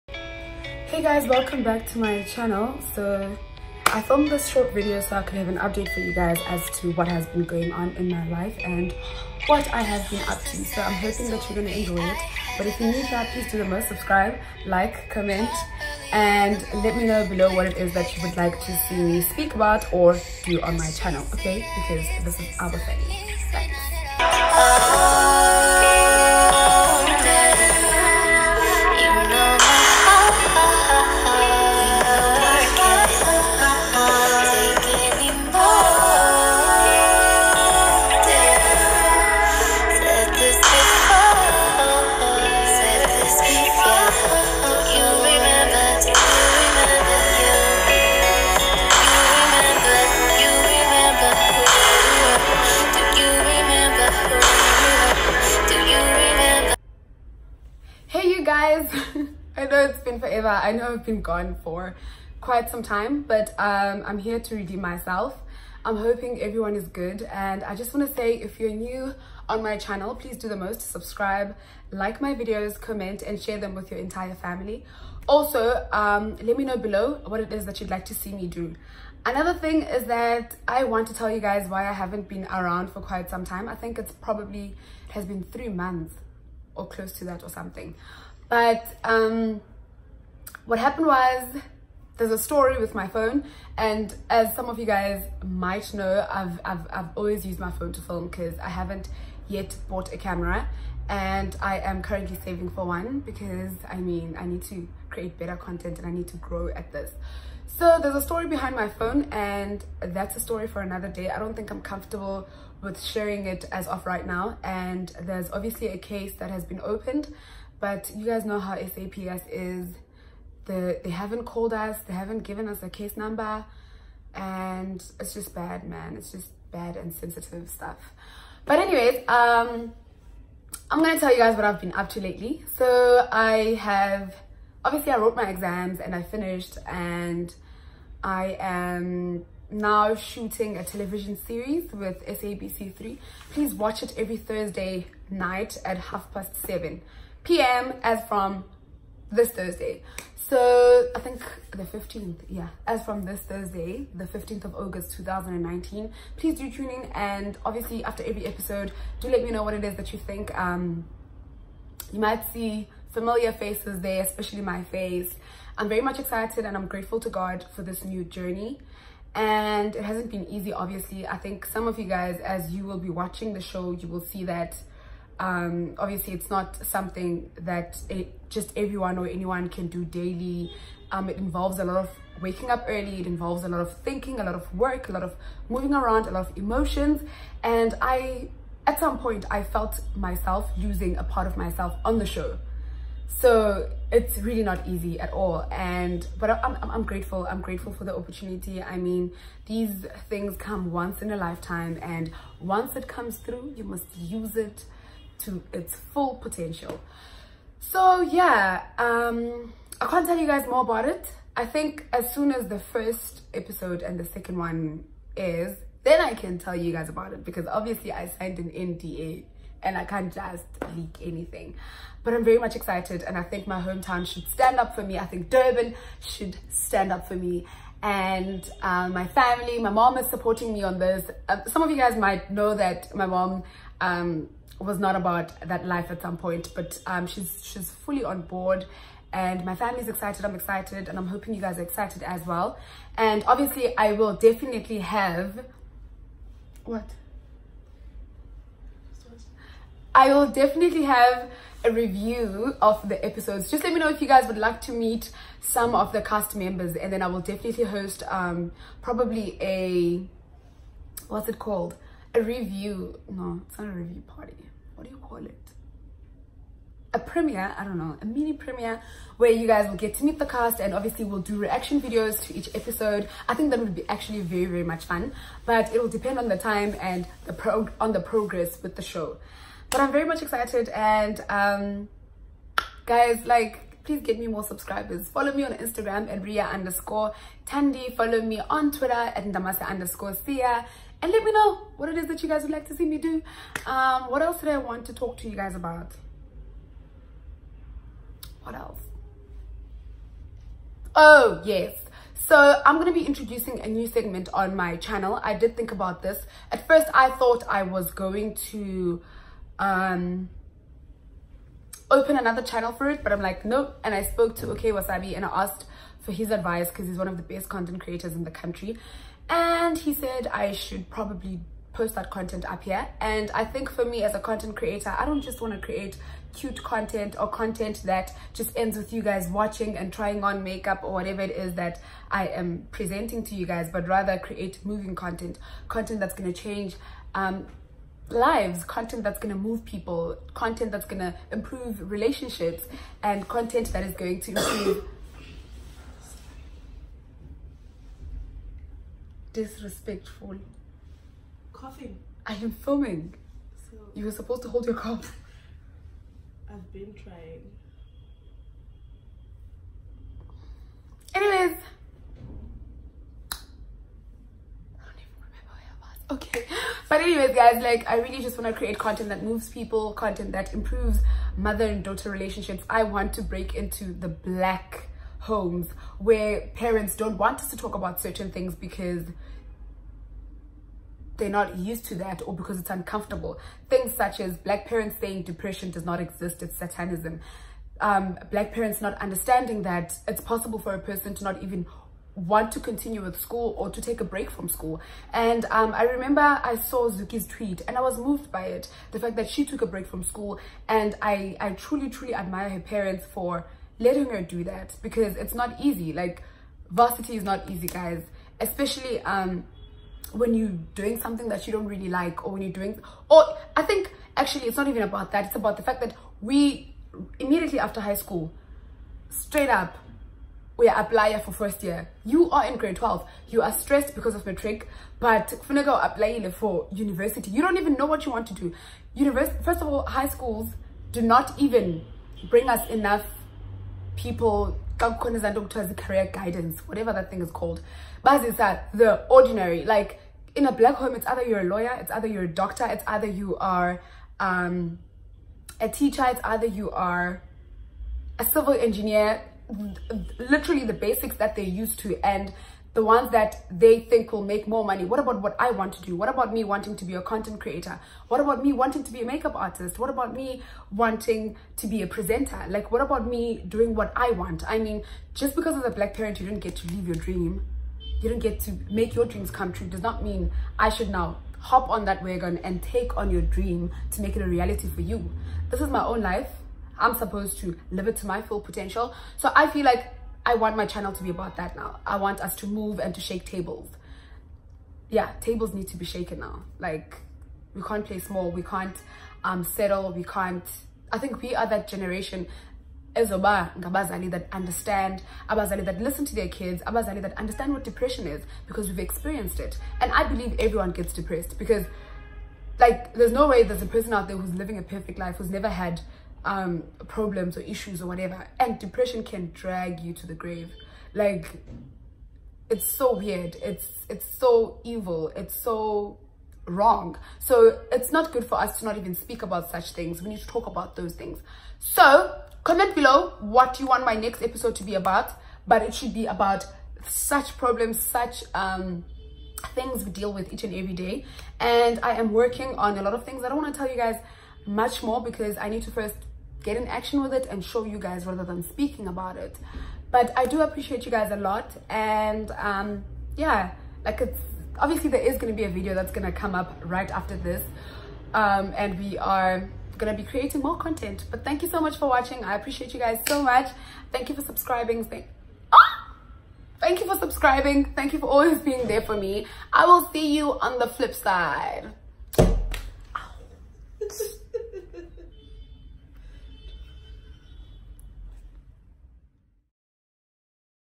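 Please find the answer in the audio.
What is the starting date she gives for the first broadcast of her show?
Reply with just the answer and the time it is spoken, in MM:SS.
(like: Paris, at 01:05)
15 August 2019, at 02:34.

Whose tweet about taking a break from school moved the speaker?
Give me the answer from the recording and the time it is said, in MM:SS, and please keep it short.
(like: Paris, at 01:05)
Zuki, at 06:37.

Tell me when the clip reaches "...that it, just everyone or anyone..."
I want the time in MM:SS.
02:57.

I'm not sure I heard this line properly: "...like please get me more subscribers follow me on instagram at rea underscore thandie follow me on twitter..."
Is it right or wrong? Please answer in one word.
right.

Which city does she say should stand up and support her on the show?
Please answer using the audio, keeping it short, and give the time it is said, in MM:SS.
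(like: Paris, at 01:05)
Durban, at 03:45.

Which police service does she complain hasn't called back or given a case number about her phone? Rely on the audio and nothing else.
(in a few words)
SAPS.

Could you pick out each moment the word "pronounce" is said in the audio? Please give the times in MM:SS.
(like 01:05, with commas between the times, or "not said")
not said.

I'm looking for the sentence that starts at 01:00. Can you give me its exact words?
I know I've been gone for quite some time, but um, I'm here to redeem myself.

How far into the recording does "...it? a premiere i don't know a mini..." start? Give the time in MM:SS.
04:25.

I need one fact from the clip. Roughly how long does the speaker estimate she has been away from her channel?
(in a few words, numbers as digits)
3 months.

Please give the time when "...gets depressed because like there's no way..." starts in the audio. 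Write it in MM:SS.
08:20.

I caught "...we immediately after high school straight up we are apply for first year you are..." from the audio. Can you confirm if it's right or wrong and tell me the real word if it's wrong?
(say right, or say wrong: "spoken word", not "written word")
right.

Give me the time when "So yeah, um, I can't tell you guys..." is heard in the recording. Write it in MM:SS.
03:27.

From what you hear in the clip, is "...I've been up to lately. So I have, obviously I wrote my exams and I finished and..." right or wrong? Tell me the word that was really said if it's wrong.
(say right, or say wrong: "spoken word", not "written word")
right.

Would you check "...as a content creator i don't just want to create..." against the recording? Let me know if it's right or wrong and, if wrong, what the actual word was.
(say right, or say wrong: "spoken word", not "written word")
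right.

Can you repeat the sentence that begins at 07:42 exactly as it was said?
Like, what about me doing what I want?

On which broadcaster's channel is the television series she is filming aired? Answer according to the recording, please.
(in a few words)
SABC3.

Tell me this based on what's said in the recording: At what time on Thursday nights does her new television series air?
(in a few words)
7:30 pm.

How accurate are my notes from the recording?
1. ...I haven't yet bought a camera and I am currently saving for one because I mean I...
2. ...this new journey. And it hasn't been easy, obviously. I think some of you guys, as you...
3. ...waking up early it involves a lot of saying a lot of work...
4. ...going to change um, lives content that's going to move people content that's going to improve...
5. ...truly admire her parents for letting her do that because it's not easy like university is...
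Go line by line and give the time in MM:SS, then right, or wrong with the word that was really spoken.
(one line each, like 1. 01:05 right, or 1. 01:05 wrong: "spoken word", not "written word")
1. 01:38 right
2. 02:47 right
3. 03:02 wrong: "thinking", not "saying"
4. 05:36 right
5. 06:42 wrong: "varsity", not "university".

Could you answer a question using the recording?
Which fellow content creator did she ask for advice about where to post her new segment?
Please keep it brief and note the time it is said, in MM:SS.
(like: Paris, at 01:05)
Okay Wasabi, at 05:14.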